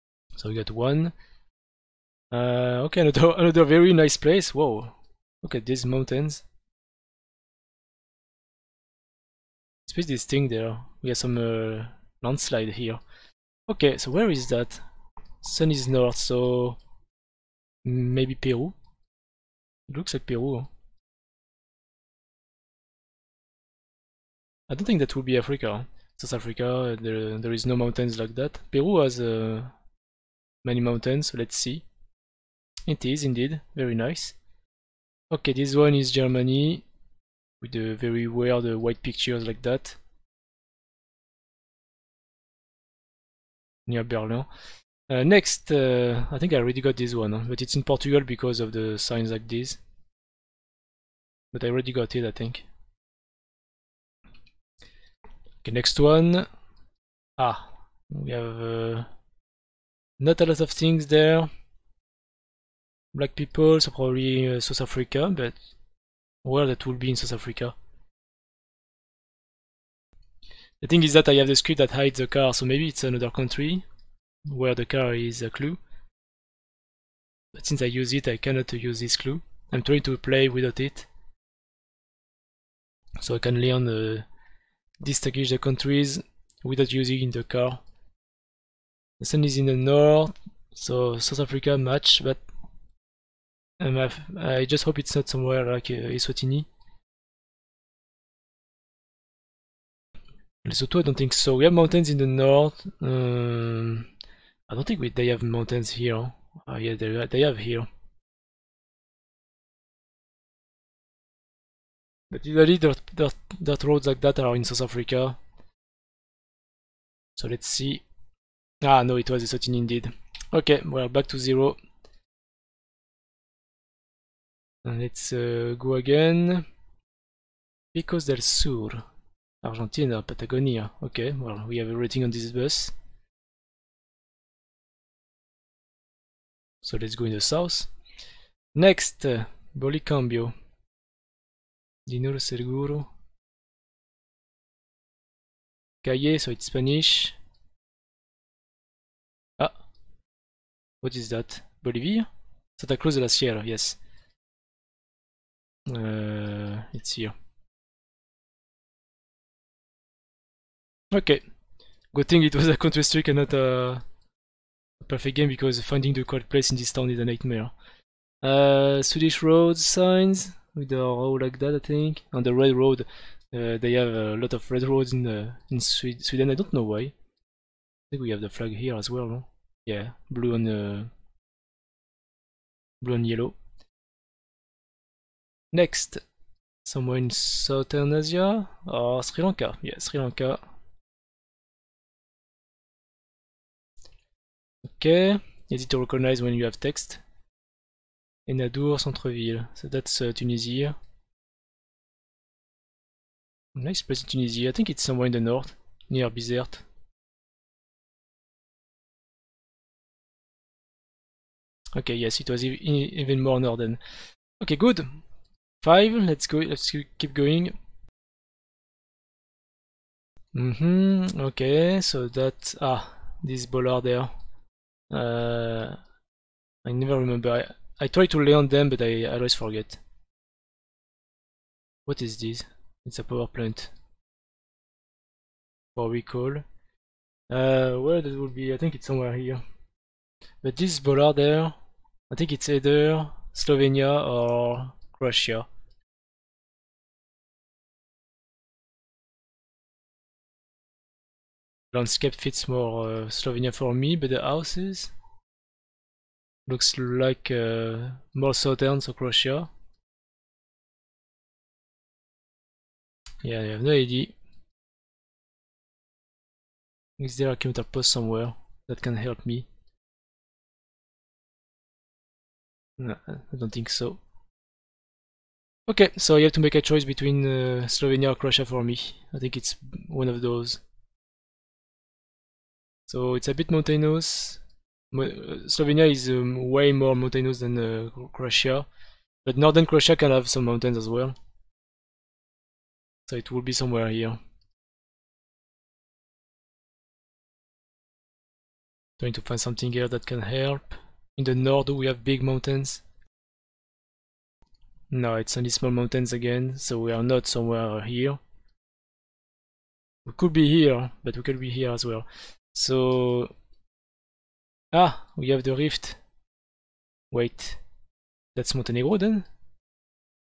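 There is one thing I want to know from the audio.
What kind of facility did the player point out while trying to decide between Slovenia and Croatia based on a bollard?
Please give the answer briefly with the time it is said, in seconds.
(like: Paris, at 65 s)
A power plant, at 233 s.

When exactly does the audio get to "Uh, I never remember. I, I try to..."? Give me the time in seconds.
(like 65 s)
225 s.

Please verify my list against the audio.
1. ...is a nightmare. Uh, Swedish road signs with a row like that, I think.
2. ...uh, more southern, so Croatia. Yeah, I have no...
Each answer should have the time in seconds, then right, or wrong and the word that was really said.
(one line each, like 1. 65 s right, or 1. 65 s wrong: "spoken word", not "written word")
1. 167 s right
2. 257 s right.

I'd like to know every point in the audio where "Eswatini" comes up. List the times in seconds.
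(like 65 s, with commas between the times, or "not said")
96 s, 119 s.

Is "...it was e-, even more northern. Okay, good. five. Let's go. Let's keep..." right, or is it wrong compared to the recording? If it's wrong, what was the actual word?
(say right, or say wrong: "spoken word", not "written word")
right.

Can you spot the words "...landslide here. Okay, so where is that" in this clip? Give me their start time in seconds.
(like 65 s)
12 s.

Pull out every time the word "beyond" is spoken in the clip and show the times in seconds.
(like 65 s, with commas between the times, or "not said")
not said.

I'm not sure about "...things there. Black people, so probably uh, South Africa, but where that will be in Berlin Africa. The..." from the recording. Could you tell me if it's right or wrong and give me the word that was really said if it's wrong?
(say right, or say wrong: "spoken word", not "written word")
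wrong: "South", not "Berlin".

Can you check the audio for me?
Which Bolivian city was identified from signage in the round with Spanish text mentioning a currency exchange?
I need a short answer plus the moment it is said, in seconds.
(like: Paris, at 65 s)
Santa Cruz de la Sierra, at 152 s.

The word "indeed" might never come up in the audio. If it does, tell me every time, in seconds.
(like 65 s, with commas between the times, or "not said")
33 s, 119 s.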